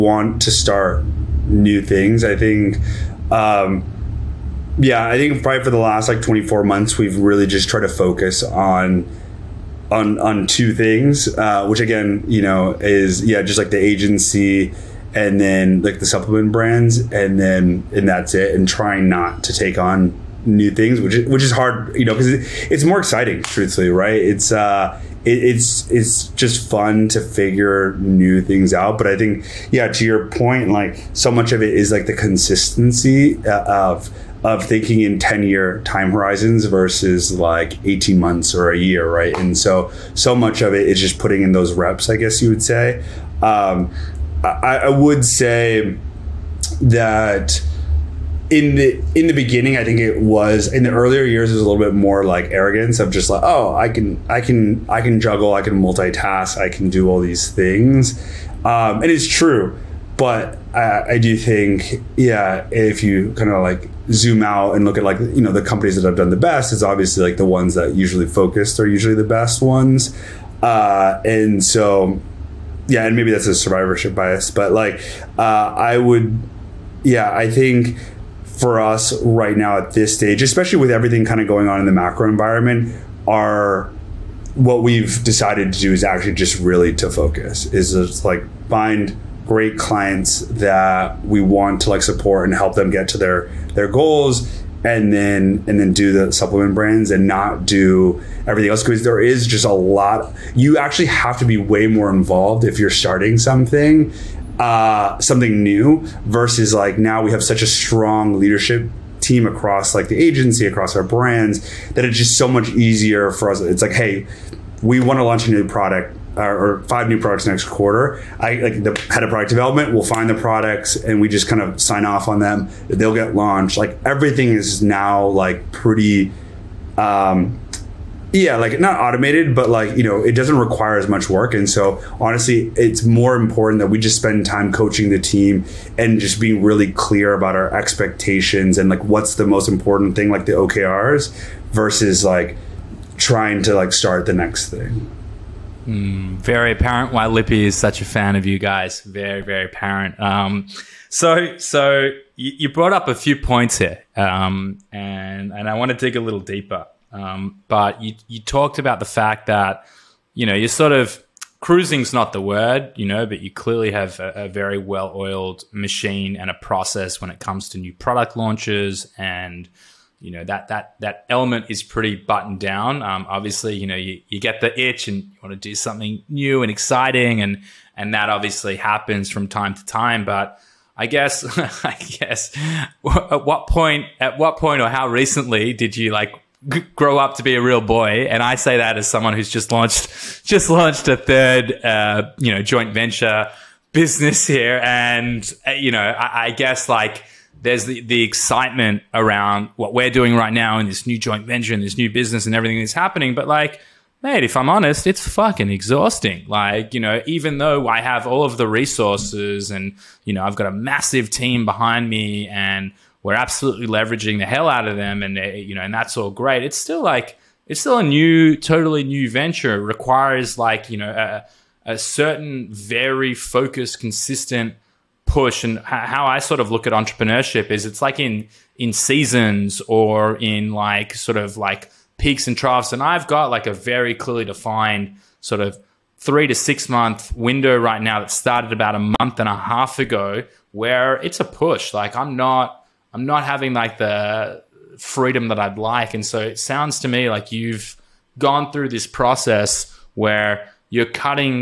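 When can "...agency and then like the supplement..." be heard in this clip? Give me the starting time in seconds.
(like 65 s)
13 s.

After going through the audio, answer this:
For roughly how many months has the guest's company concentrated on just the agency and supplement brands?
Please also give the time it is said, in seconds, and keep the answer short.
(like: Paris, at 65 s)
24 months, at 6 s.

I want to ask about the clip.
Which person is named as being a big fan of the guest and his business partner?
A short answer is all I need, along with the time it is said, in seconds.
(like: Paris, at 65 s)
Lippy, at 147 s.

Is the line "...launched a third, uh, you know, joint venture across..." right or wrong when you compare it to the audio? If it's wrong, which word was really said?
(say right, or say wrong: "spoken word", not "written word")
wrong: "business", not "across".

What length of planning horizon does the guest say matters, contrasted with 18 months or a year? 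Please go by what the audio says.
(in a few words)
10 year.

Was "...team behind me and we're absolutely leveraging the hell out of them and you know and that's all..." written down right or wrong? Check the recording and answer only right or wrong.
right.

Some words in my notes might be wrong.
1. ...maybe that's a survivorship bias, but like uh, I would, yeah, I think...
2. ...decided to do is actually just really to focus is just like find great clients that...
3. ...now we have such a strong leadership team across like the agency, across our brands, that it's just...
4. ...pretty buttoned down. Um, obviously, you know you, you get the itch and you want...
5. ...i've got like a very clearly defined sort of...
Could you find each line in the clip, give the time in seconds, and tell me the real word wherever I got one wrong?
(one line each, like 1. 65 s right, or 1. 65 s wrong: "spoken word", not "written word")
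1. 73 s right
2. 85 s right
3. 106 s right
4. 171 s right
5. 233 s right.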